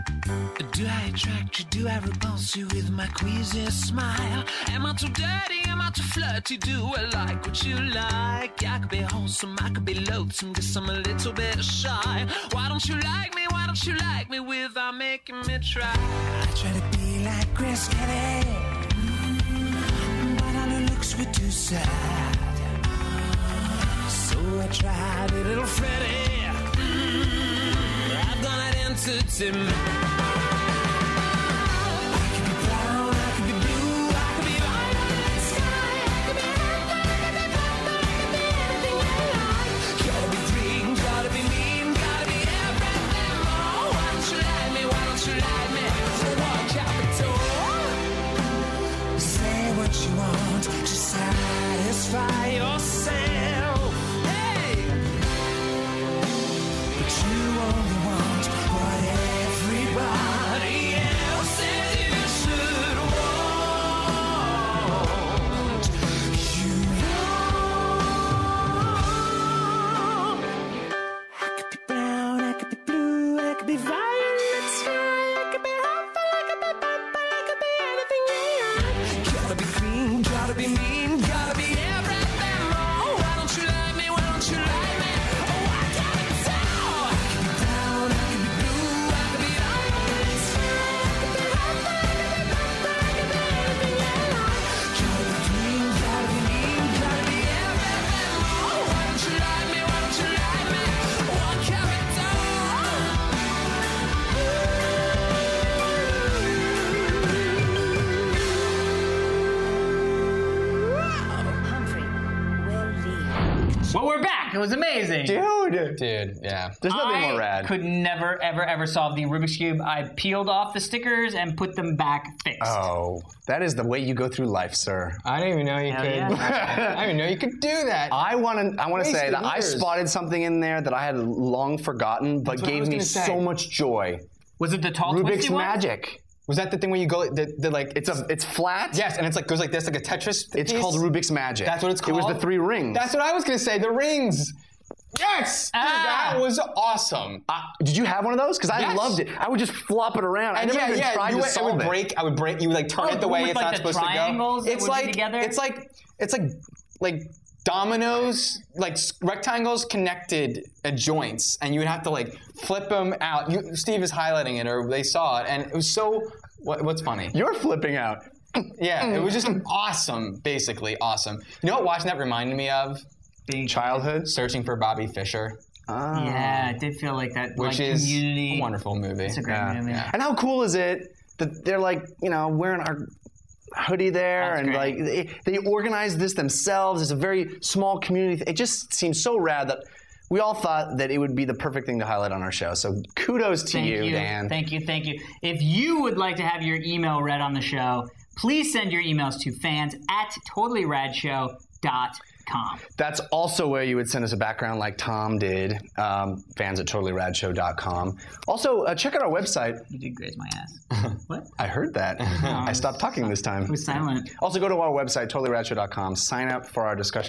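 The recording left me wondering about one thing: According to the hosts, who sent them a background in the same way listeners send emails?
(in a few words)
Tom.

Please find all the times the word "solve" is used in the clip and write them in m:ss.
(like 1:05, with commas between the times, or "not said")
1:58, 2:31.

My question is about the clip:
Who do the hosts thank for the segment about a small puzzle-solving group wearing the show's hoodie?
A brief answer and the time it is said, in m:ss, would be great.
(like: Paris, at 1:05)
Dan, at 3:14.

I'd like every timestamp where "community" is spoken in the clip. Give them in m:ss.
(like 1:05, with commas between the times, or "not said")
2:58, 3:07.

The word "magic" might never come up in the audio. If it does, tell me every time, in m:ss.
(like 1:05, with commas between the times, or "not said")
2:15, 2:21.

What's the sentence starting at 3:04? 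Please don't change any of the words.
like they, they organized this themselves.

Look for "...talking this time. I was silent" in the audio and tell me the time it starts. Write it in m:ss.
3:32.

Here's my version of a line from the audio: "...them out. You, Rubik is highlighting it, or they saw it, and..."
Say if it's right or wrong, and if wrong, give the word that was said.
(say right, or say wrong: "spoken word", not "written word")
wrong: "Steve", not "Rubik".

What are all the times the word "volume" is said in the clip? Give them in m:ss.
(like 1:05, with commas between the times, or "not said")
not said.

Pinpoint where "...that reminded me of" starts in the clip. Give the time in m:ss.
2:52.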